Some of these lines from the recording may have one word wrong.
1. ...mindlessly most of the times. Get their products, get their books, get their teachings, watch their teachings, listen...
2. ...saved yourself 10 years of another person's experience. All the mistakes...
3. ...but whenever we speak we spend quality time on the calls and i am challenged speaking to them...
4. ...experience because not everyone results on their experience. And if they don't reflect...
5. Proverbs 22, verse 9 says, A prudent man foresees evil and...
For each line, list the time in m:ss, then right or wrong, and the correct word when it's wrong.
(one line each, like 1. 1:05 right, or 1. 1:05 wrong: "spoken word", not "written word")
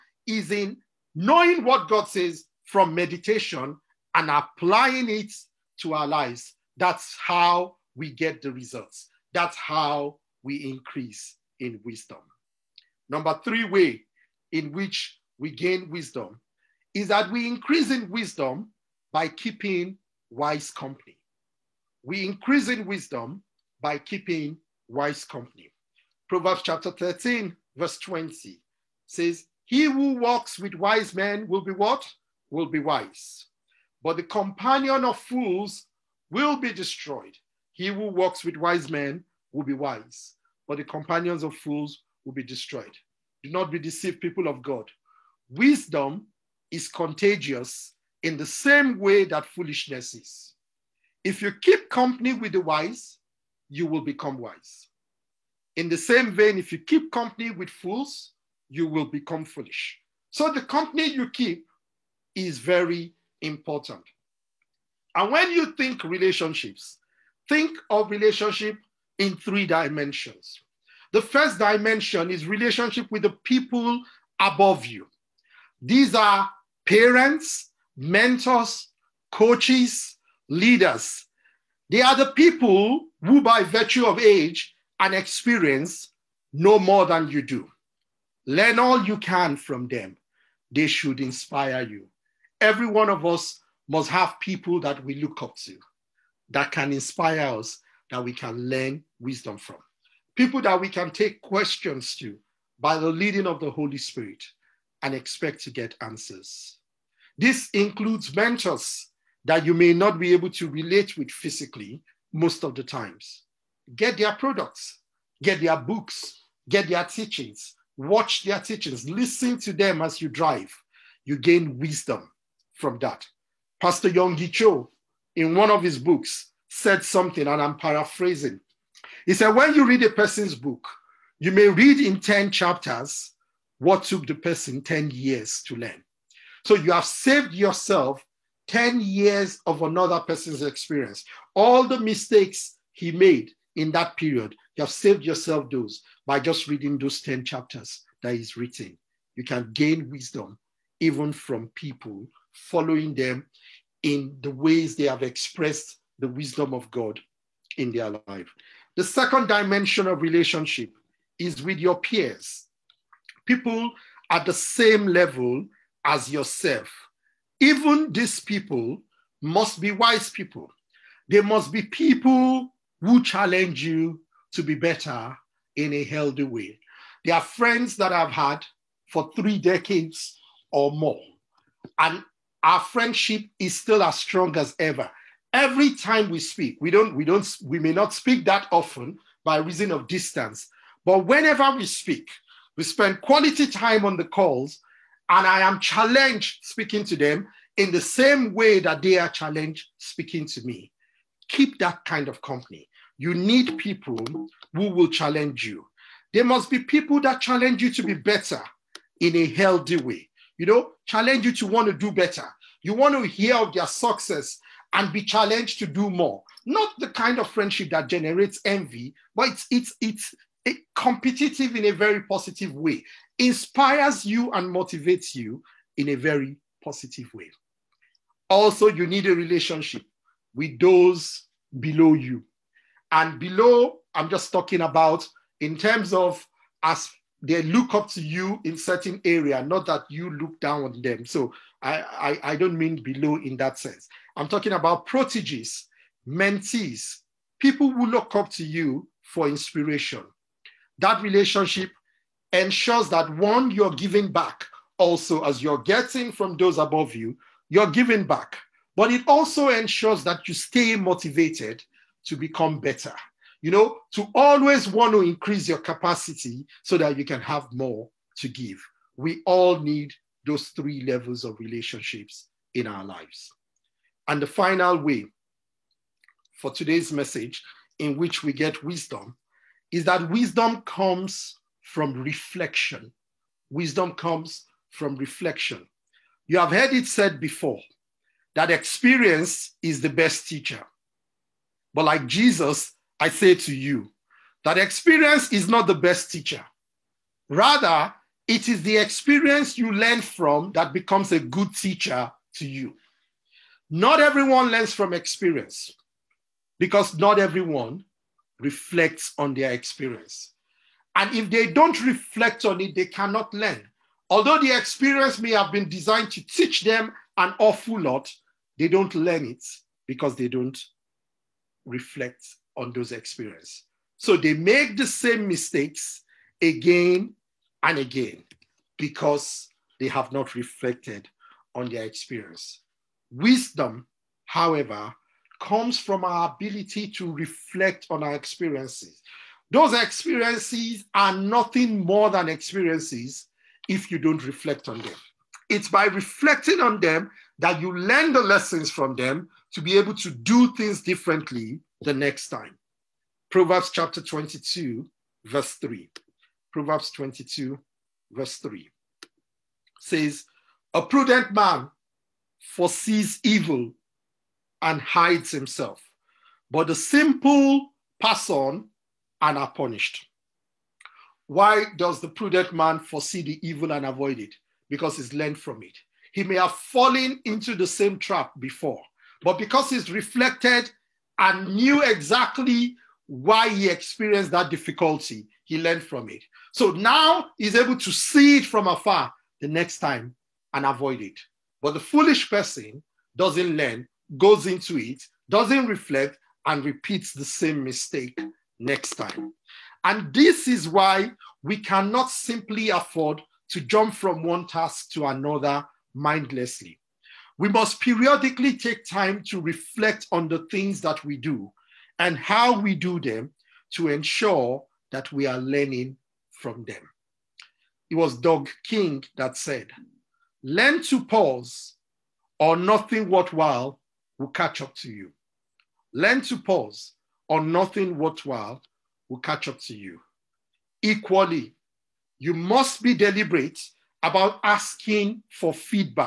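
1. 1:51 wrong: "physically", not "mindlessly"
2. 2:17 right
3. 3:11 right
4. 5:05 wrong: "reflects", not "results"
5. 5:56 wrong: "3", not "9".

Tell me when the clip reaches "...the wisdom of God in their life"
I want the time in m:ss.
2:36.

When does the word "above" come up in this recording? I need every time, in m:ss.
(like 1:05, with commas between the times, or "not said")
1:14, 4:16.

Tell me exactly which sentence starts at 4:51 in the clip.
But like Jesus, I say to you that experience is not the best teacher.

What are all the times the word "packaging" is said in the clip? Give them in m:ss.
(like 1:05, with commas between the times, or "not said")
not said.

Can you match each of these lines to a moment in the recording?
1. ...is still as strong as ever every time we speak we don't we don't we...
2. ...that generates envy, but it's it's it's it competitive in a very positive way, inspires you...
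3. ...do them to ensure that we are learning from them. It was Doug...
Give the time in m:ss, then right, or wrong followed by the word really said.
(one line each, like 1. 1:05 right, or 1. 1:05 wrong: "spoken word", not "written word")
1. 3:03 right
2. 3:37 right
3. 6:52 right.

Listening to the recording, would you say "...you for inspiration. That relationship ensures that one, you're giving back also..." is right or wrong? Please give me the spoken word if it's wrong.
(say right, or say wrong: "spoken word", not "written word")
right.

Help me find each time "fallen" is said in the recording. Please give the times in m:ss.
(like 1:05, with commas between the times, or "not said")
6:16.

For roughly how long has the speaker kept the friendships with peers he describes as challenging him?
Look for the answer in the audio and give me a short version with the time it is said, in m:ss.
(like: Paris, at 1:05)
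three decades, at 2:59.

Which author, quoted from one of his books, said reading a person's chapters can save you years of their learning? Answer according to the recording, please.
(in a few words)
Yonggi Cho.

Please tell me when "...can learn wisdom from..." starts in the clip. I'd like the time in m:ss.
1:38.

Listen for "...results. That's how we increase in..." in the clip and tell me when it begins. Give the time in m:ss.
0:08.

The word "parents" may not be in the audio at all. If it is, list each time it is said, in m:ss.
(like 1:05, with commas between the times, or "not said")
1:16.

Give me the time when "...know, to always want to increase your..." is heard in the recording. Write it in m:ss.
4:23.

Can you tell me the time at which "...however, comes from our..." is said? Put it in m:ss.
5:34.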